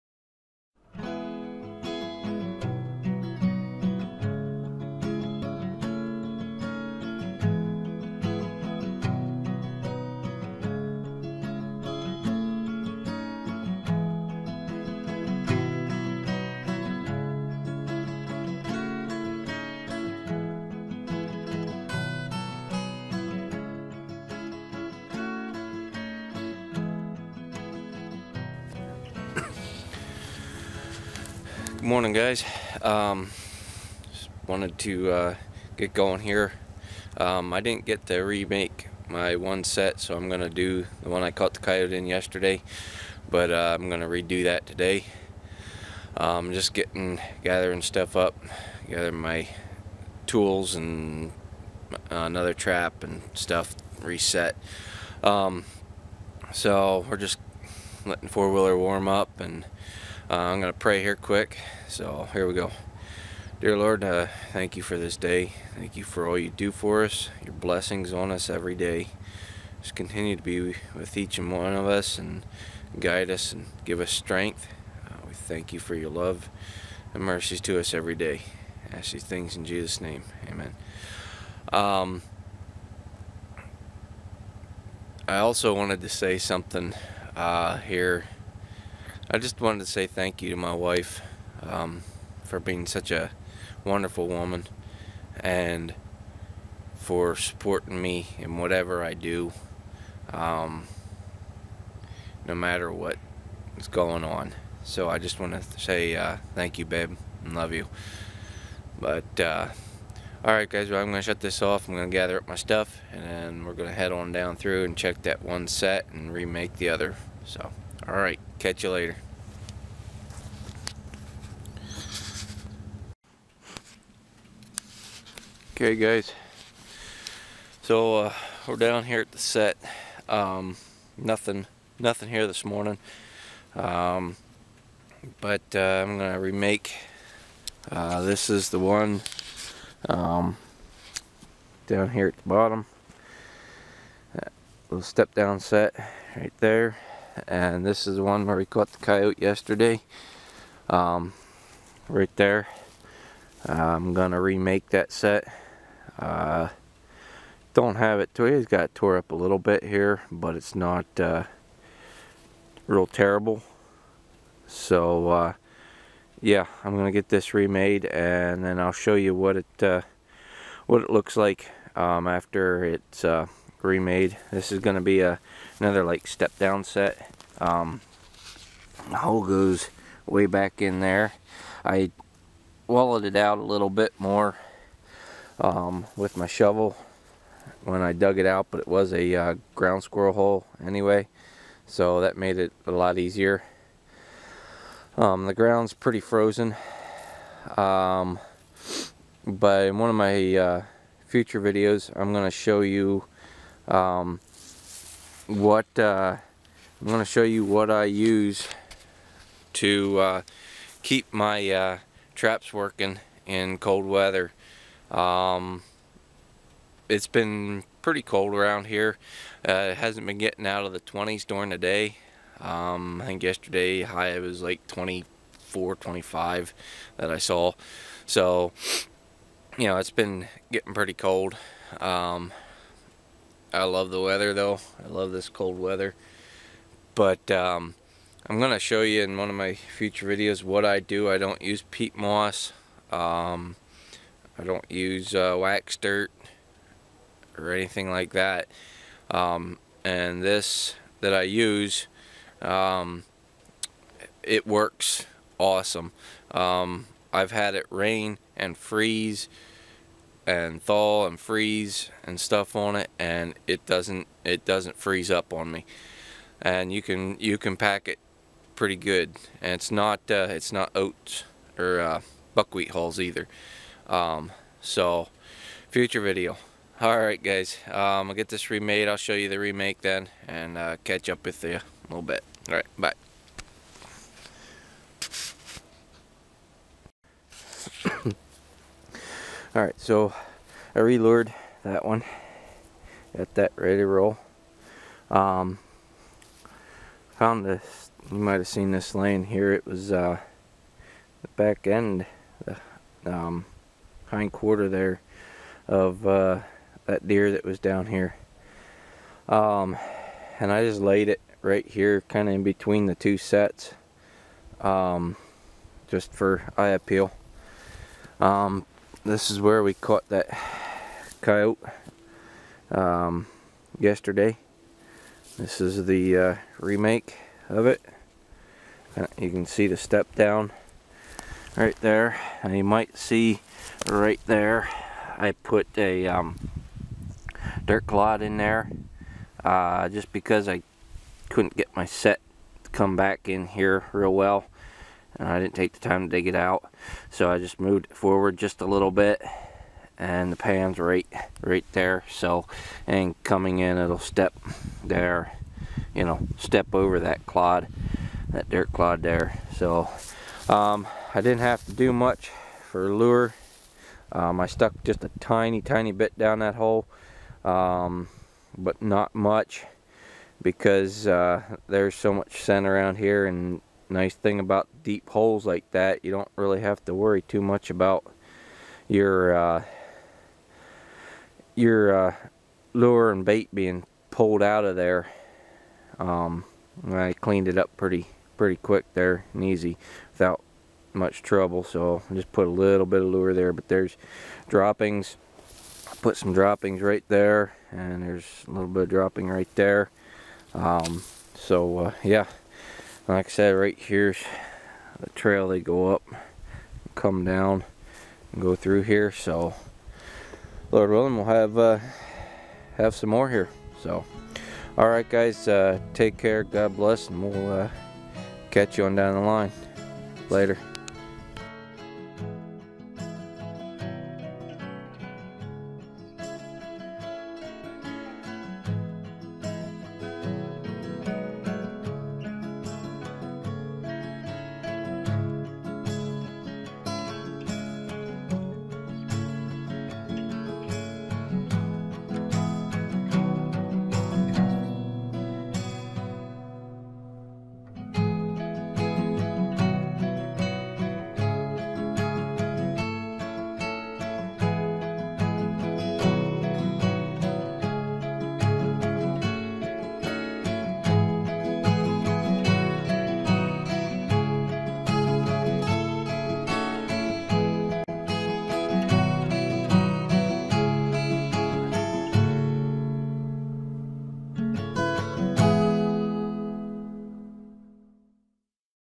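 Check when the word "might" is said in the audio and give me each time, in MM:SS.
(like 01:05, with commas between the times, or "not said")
04:58, 05:32.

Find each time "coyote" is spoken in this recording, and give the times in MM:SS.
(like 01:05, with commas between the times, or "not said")
00:41, 02:29, 05:21.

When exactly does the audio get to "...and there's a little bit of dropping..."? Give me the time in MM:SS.
06:37.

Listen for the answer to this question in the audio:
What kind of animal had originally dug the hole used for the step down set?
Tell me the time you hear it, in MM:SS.
03:09.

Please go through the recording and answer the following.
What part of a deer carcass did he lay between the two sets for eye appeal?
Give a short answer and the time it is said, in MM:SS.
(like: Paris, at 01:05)
Hind quarter, at 05:04.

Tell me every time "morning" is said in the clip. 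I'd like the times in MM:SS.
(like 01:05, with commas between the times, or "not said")
00:31, 02:12.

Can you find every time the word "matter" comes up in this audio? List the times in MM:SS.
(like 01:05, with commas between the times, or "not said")
01:42.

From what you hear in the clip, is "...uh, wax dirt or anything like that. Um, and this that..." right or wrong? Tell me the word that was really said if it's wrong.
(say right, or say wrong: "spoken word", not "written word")
right.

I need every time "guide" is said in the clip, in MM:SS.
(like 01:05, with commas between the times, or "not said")
01:12.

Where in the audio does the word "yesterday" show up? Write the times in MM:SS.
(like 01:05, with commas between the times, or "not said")
00:42, 02:29, 03:43, 05:23.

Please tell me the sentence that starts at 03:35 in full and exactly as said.
Um, it's been pretty cold around here.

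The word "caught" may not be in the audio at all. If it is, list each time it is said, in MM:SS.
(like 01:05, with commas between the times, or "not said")
00:41, 02:28, 05:19.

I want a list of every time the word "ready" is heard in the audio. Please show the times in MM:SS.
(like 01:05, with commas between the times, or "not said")
04:53.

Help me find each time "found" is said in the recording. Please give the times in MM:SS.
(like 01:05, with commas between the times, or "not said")
04:57.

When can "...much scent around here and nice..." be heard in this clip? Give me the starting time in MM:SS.
06:12.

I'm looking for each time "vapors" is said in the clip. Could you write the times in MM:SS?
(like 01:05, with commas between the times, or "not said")
not said.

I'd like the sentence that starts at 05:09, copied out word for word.
Um, and I just laid it right here, kind of in between the two sets, um, just for eye appeal.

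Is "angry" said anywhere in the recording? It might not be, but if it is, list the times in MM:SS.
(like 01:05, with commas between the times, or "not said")
not said.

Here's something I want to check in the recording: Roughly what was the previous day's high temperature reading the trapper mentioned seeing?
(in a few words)
24.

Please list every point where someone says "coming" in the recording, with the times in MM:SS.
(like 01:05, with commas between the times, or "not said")
05:53.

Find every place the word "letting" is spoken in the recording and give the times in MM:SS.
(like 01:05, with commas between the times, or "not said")
00:58.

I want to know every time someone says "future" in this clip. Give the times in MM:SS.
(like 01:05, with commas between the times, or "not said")
03:21, 03:59, 04:35.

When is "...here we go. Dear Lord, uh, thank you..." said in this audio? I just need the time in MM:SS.
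01:02.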